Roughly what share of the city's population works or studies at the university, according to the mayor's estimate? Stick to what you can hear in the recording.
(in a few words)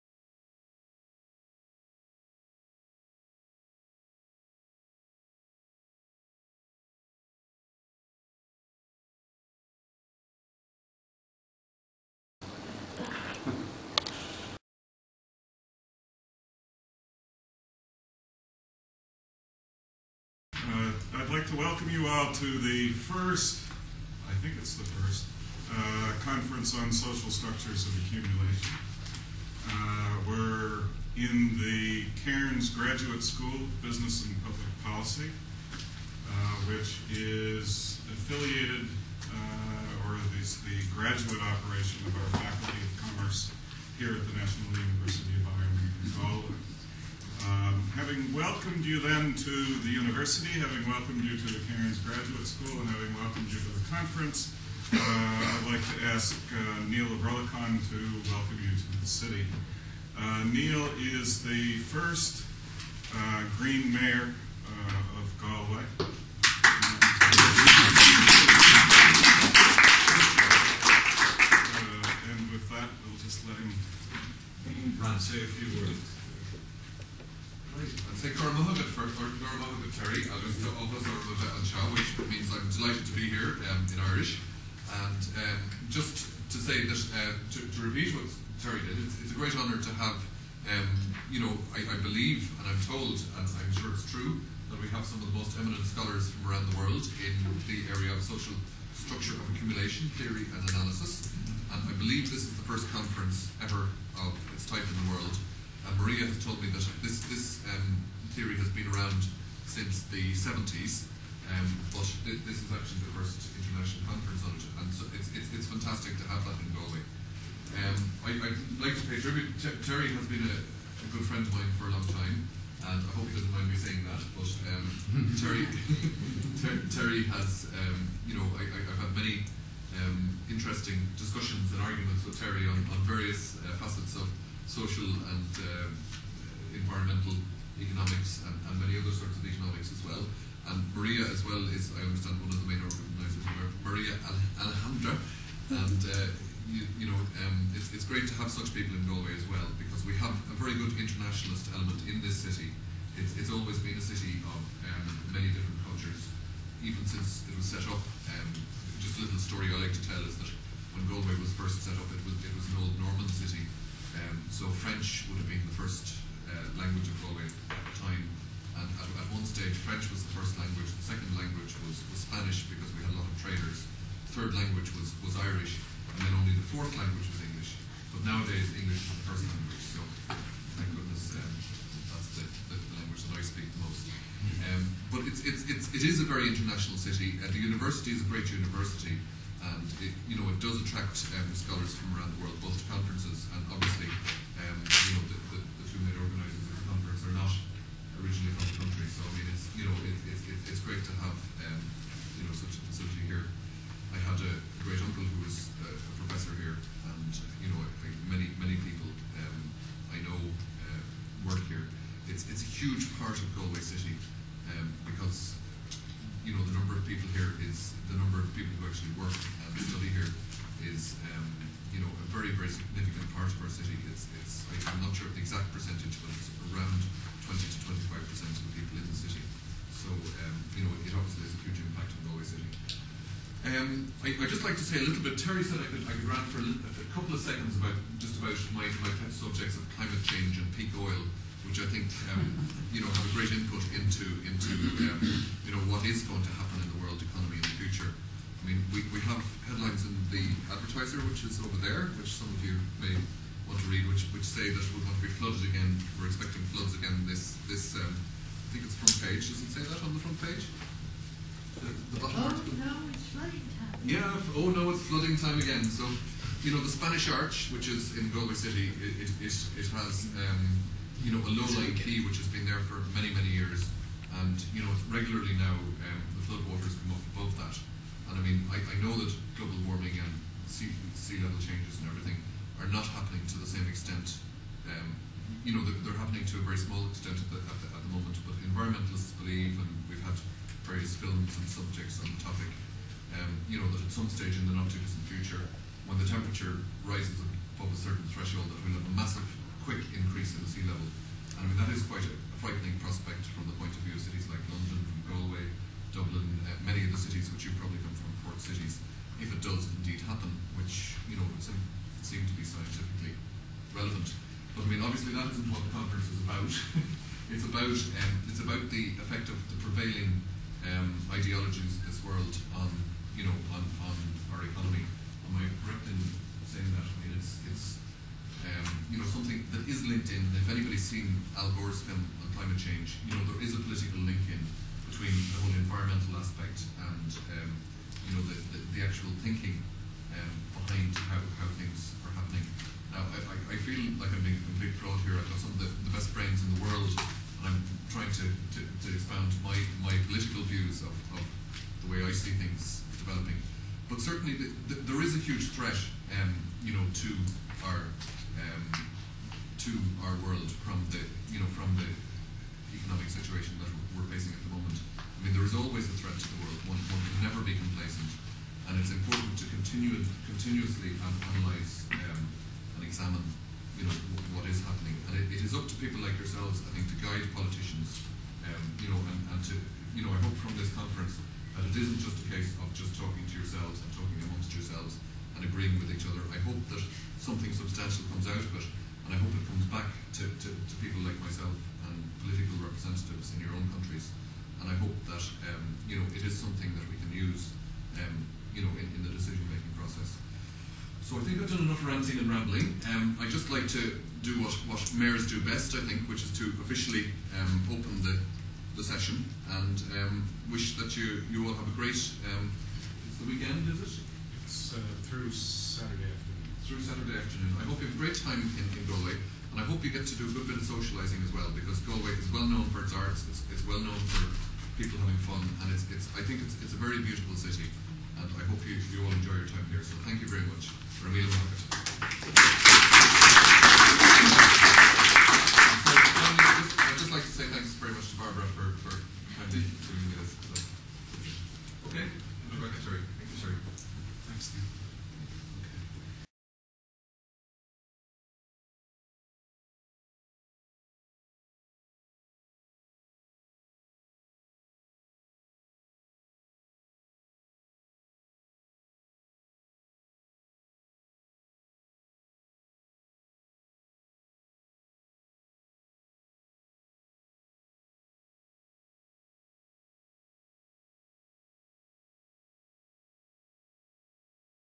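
20 to 25 percent.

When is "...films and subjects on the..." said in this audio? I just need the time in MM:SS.
04:51.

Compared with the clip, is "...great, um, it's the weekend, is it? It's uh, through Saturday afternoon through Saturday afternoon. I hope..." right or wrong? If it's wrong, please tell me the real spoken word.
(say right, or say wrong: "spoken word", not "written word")
right.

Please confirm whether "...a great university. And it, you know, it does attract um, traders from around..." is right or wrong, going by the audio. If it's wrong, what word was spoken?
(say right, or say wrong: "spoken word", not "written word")
wrong: "scholars", not "traders".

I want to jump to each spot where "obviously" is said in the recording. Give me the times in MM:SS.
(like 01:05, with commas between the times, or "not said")
03:51, 05:15.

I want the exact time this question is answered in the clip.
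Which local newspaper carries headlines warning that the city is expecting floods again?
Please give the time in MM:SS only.
04:10.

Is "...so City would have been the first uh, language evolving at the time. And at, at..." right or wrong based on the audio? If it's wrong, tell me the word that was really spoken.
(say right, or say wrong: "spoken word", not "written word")
wrong: "French", not "City".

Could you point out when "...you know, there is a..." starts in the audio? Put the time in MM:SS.
05:33.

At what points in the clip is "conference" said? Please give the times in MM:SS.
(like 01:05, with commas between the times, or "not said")
00:26, 00:53, 01:42, 01:54, 05:15, 06:20.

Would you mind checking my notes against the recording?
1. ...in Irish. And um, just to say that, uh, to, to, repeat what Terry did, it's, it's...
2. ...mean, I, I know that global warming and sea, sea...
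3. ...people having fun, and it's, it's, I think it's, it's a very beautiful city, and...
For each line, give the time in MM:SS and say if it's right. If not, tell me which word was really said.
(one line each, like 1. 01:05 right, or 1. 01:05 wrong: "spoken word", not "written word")
1. 01:23 right
2. 04:38 right
3. 07:04 right.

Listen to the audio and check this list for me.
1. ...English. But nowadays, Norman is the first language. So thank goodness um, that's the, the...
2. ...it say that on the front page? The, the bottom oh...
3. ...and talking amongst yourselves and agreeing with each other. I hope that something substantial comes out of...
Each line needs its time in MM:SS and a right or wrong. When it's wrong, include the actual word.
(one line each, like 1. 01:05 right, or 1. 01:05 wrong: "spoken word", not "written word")
1. 02:57 wrong: "English", not "Norman"
2. 04:19 right
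3. 06:24 right.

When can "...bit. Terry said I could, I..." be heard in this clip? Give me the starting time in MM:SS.
03:55.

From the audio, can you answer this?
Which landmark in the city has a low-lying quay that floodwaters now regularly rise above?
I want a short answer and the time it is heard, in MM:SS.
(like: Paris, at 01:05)
Spanish Arch, at 04:26.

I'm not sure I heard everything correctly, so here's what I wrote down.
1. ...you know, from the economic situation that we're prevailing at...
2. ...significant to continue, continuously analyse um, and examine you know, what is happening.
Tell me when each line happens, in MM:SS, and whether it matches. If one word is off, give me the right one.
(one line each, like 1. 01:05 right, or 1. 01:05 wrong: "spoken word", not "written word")
1. 06:01 wrong: "facing", not "prevailing"
2. 06:09 wrong: "important", not "significant".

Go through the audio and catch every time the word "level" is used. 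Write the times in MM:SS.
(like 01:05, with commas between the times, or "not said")
04:41, 05:00.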